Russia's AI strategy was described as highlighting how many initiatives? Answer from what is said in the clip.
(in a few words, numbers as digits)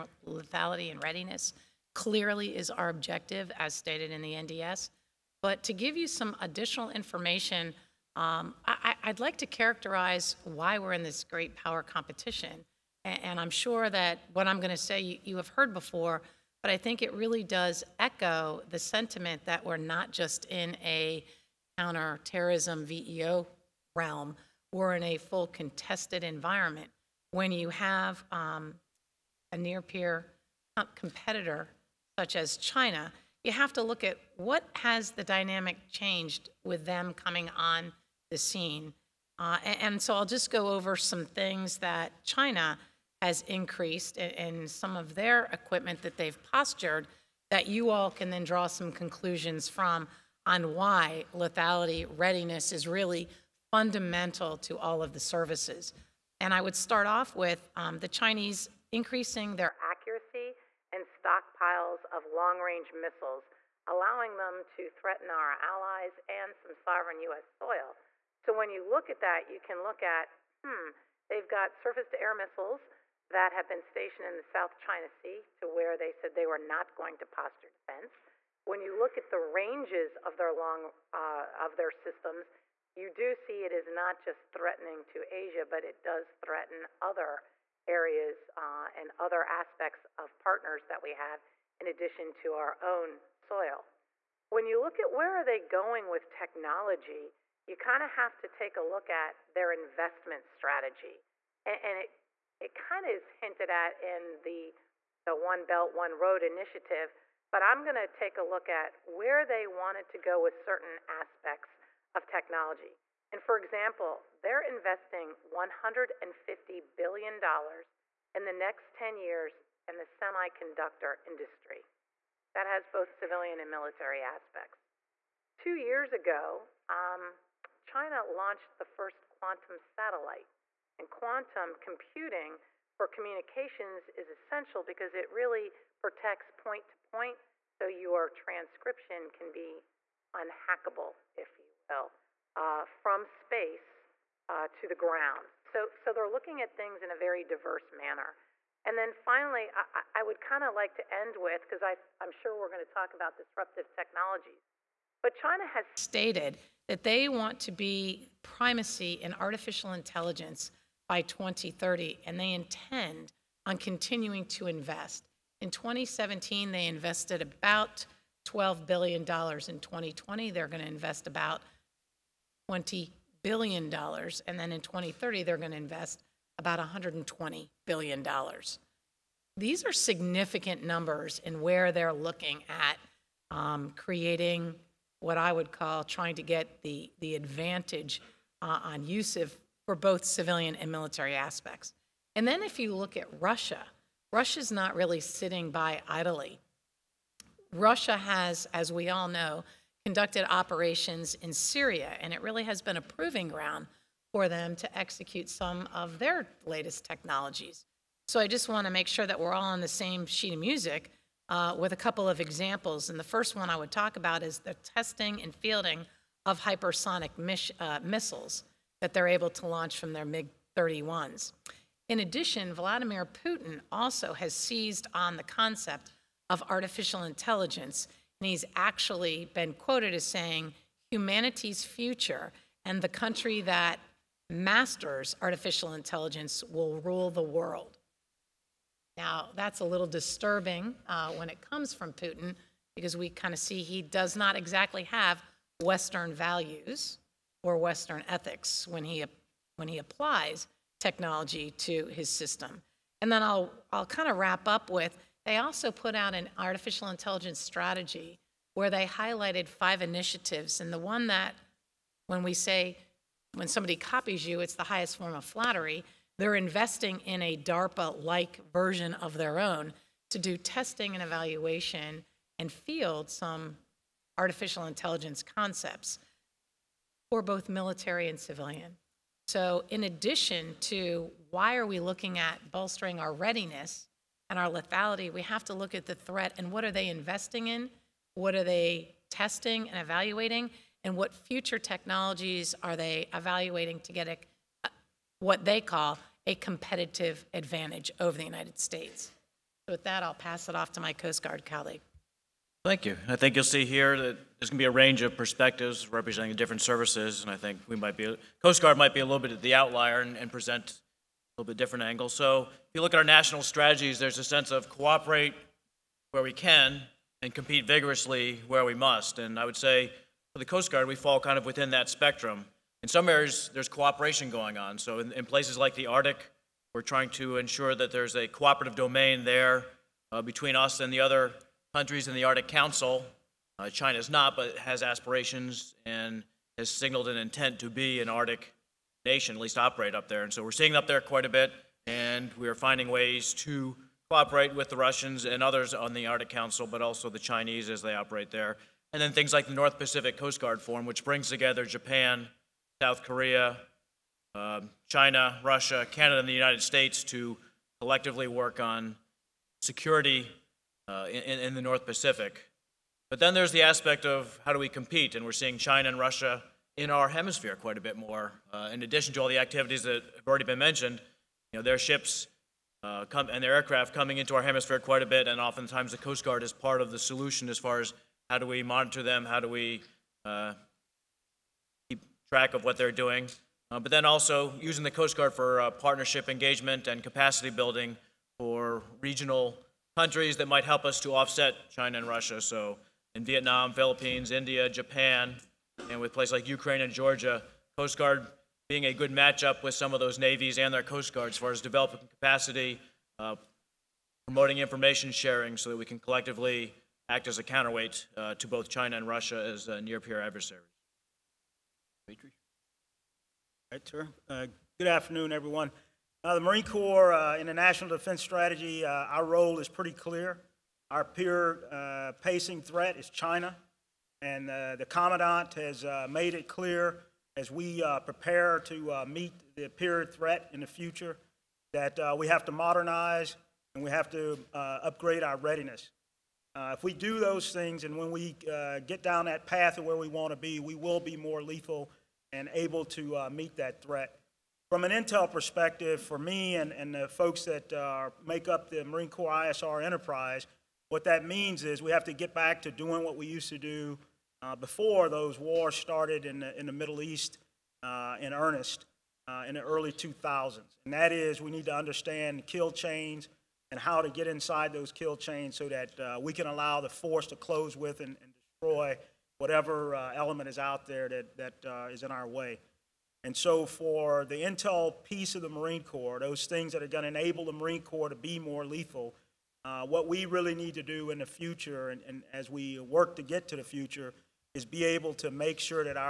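5.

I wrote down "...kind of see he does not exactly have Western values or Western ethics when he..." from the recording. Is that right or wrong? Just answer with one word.
right.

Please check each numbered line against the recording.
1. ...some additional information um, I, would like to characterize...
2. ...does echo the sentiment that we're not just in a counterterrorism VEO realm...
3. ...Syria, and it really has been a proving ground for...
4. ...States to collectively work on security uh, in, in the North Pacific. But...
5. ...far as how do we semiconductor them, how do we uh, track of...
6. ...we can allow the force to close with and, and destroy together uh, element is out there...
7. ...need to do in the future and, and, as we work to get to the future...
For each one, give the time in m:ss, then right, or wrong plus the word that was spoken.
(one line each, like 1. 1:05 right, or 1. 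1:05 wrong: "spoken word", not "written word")
1. 0:06 right
2. 0:17 right
3. 3:21 right
4. 5:56 right
5. 6:17 wrong: "monitor", not "semiconductor"
6. 7:46 wrong: "whatever", not "together"
7. 8:00 right.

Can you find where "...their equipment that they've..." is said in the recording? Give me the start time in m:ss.
0:45.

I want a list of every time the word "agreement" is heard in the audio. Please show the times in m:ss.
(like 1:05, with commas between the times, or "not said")
not said.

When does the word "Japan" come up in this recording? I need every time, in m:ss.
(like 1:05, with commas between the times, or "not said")
5:51, 6:34.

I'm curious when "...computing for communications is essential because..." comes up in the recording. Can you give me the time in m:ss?
2:11.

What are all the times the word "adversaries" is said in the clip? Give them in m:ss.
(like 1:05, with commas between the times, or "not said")
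6:50.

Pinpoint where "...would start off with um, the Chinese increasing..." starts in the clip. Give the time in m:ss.
0:56.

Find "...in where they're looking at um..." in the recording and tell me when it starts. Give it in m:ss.
3:01.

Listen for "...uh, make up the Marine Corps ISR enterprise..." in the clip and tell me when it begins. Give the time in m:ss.
7:27.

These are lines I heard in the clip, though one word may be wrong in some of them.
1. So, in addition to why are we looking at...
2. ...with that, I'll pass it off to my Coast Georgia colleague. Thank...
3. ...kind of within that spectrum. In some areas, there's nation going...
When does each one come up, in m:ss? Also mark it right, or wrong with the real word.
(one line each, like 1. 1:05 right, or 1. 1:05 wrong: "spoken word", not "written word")
1. 4:39 right
2. 4:59 wrong: "Guard", not "Georgia"
3. 5:21 wrong: "cooperation", not "nation".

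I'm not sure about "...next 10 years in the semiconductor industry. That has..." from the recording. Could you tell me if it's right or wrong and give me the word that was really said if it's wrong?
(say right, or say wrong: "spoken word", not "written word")
right.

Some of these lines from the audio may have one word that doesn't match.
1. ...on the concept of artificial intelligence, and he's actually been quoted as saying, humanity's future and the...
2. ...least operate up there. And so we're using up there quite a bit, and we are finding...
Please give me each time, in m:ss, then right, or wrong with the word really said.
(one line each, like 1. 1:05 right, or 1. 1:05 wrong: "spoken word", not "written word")
1. 3:45 right
2. 5:39 wrong: "seeing", not "using".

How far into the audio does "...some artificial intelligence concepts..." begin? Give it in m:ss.
4:33.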